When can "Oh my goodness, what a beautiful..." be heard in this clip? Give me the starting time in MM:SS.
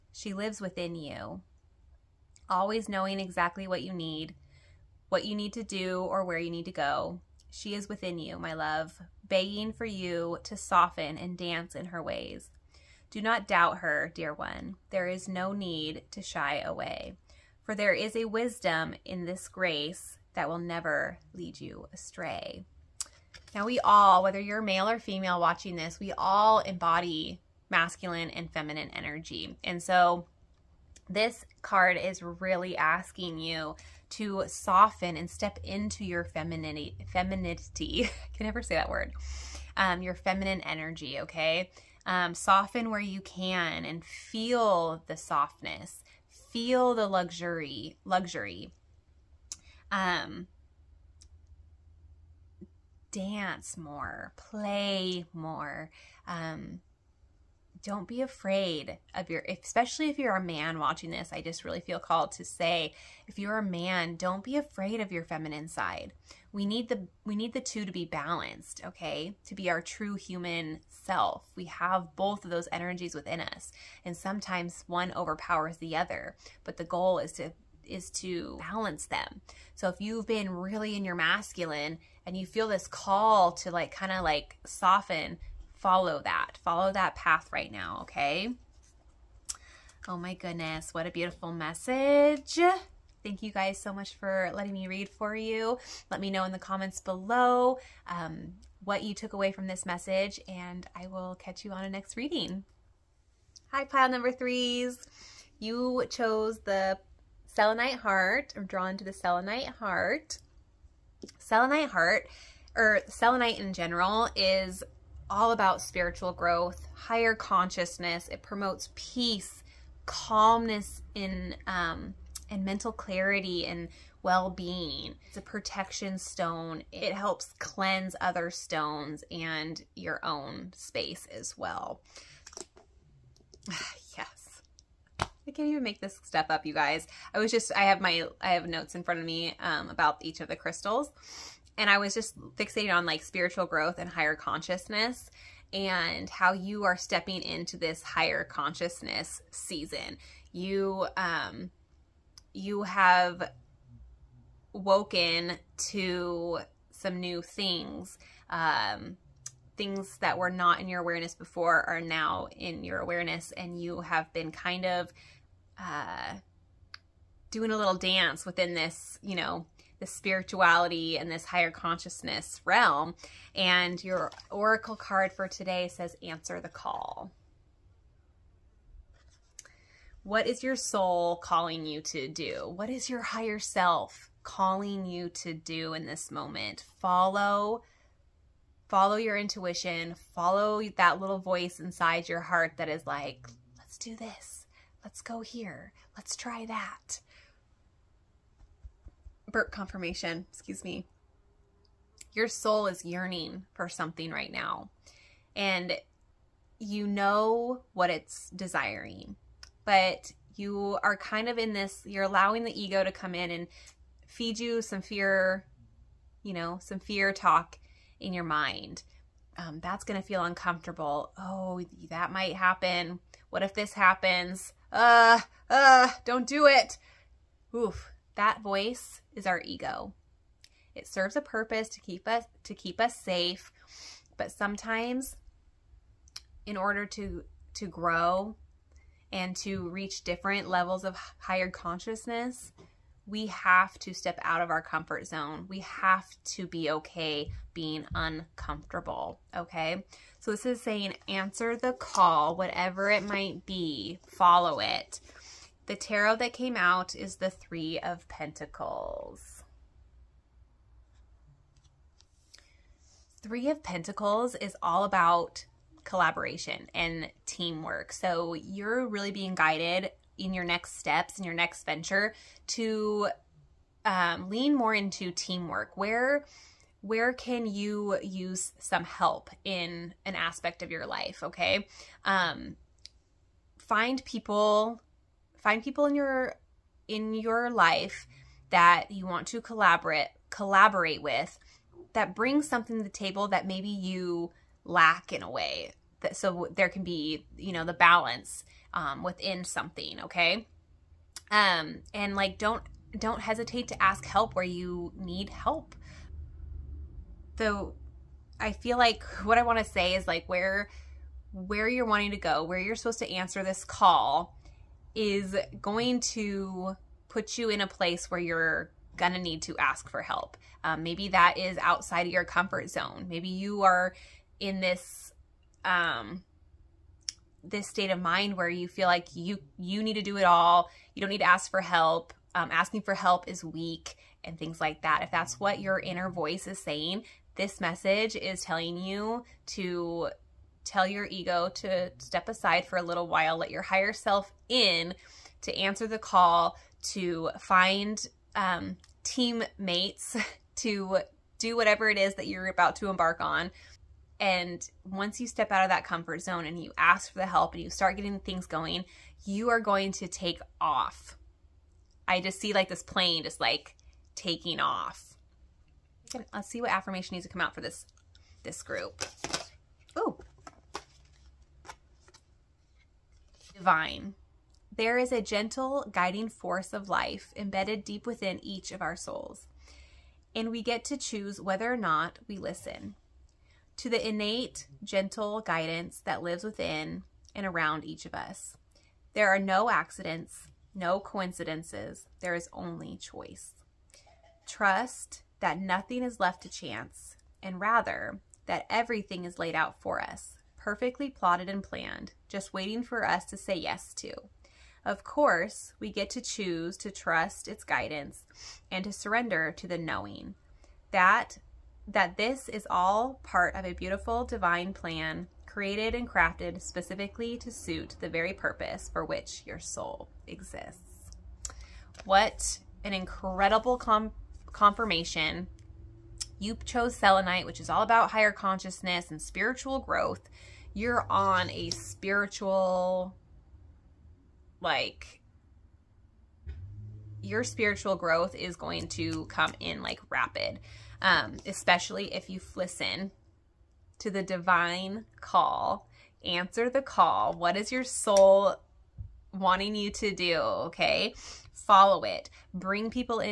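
01:30.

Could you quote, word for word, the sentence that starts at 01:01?
I just really feel called to say, if you're a man, don't be afraid of your feminine side.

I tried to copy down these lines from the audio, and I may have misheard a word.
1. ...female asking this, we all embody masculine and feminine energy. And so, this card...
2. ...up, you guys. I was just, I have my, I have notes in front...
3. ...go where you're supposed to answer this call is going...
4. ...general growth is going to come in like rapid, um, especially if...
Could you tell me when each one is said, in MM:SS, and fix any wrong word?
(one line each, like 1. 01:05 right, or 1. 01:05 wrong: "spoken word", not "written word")
1. 00:24 wrong: "watching", not "asking"
2. 02:16 right
3. 05:12 right
4. 07:17 wrong: "spiritual", not "general".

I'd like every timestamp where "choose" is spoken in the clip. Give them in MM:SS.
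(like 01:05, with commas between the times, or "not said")
06:21, 06:46.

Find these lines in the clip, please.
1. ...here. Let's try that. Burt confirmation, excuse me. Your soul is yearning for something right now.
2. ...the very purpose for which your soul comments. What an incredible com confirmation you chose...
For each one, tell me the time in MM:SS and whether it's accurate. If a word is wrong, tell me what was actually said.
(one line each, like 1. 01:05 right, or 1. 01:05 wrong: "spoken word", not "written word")
1. 03:15 right
2. 06:58 wrong: "exists", not "comments".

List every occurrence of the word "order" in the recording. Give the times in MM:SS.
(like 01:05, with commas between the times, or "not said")
03:56.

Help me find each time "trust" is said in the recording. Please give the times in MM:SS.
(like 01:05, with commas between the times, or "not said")
06:34, 06:47.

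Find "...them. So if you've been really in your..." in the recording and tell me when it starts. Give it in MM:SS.
01:19.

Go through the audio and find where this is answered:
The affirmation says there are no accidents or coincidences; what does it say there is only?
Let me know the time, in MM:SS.
06:32.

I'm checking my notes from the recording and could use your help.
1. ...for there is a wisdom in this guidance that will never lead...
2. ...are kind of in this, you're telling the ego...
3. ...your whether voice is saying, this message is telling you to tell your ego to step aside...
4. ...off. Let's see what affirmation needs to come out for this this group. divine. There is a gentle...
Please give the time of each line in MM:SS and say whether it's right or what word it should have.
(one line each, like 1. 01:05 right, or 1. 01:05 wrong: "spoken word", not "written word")
1. 00:17 wrong: "grace", not "guidance"
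2. 03:31 wrong: "allowing", not "telling"
3. 05:35 wrong: "inner", not "whether"
4. 06:04 right.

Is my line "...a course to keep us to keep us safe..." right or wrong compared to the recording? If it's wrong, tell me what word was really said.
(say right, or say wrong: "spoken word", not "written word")
wrong: "purpose", not "course".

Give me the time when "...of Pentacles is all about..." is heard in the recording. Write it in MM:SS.
04:23.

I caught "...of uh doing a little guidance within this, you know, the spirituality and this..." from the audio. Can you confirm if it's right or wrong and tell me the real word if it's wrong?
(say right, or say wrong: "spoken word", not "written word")
wrong: "dance", not "guidance".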